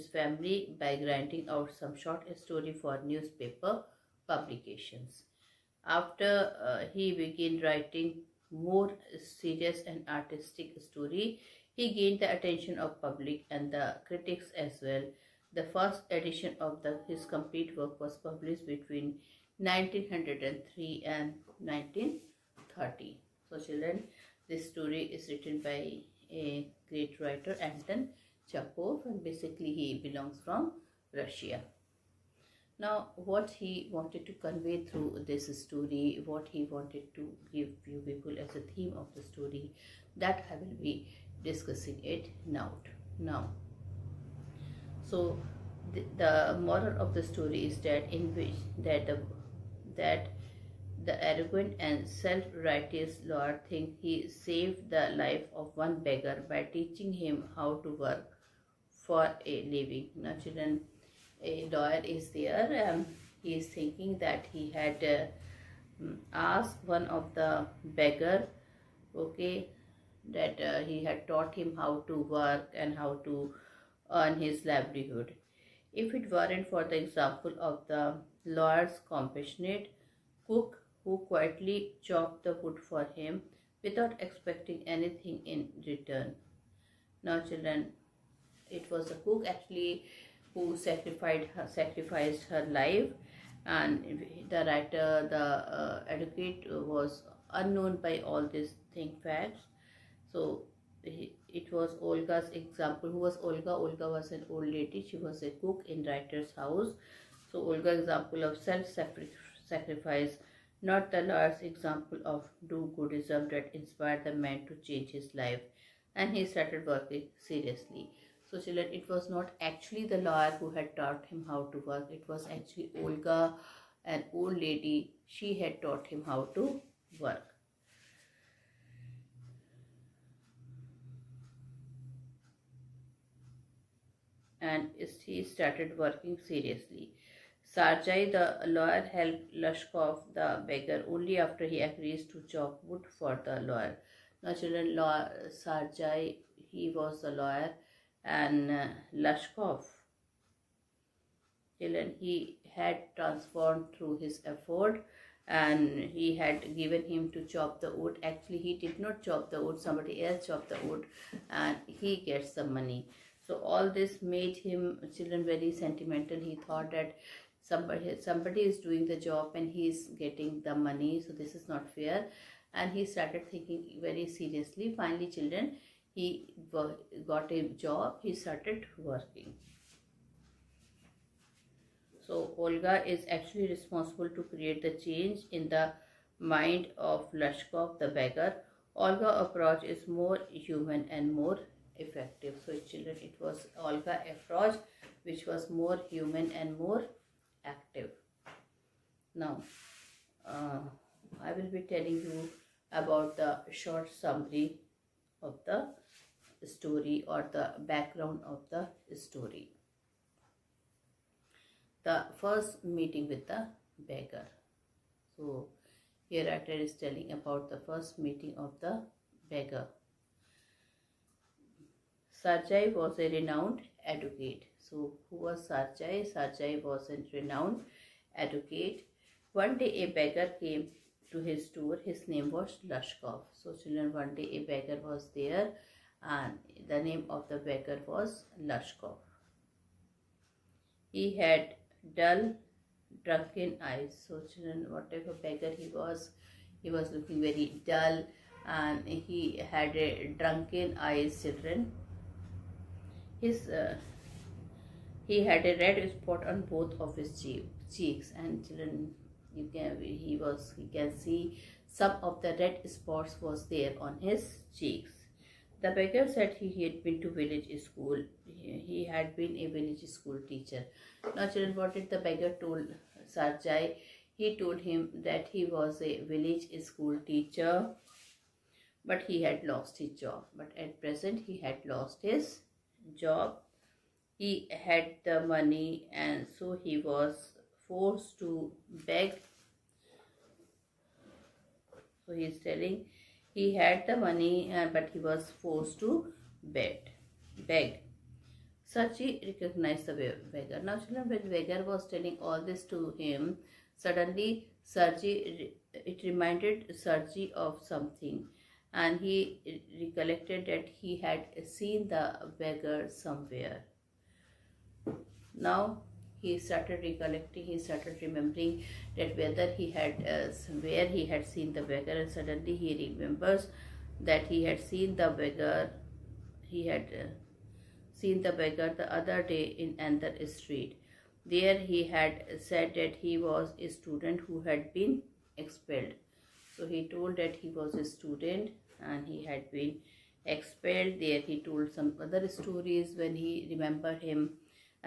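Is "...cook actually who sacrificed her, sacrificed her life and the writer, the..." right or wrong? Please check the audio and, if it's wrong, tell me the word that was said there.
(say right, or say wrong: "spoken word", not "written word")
right.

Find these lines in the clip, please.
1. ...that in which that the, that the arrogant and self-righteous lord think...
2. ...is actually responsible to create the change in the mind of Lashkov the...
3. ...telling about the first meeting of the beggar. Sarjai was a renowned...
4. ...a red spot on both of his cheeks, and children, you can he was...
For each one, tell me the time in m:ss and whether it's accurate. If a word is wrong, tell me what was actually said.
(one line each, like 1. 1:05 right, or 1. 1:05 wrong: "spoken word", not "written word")
1. 0:47 right
2. 3:03 right
3. 3:36 right
4. 4:15 right.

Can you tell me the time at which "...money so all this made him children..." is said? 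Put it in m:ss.
2:42.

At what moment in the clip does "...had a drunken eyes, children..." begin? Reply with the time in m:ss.
4:09.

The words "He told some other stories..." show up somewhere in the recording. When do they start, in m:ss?
5:41.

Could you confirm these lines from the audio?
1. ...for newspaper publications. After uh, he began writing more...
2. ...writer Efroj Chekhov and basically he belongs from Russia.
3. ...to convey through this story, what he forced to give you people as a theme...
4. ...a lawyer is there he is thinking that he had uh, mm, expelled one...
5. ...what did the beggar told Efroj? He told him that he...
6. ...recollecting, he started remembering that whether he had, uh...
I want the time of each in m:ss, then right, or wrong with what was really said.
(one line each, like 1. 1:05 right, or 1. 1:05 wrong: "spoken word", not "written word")
1. 0:02 right
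2. 0:27 wrong: "Anton", not "Efroj"
3. 0:34 wrong: "wanted", not "forced"
4. 1:01 wrong: "asked", not "expelled"
5. 4:31 wrong: "Sarjai", not "Efroj"
6. 5:17 right.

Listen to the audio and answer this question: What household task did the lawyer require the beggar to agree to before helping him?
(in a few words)
Chop wood.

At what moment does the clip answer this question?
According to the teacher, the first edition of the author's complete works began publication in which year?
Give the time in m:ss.
0:19.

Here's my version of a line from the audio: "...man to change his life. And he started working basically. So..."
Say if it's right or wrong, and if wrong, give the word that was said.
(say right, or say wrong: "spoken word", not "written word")
wrong: "seriously", not "basically".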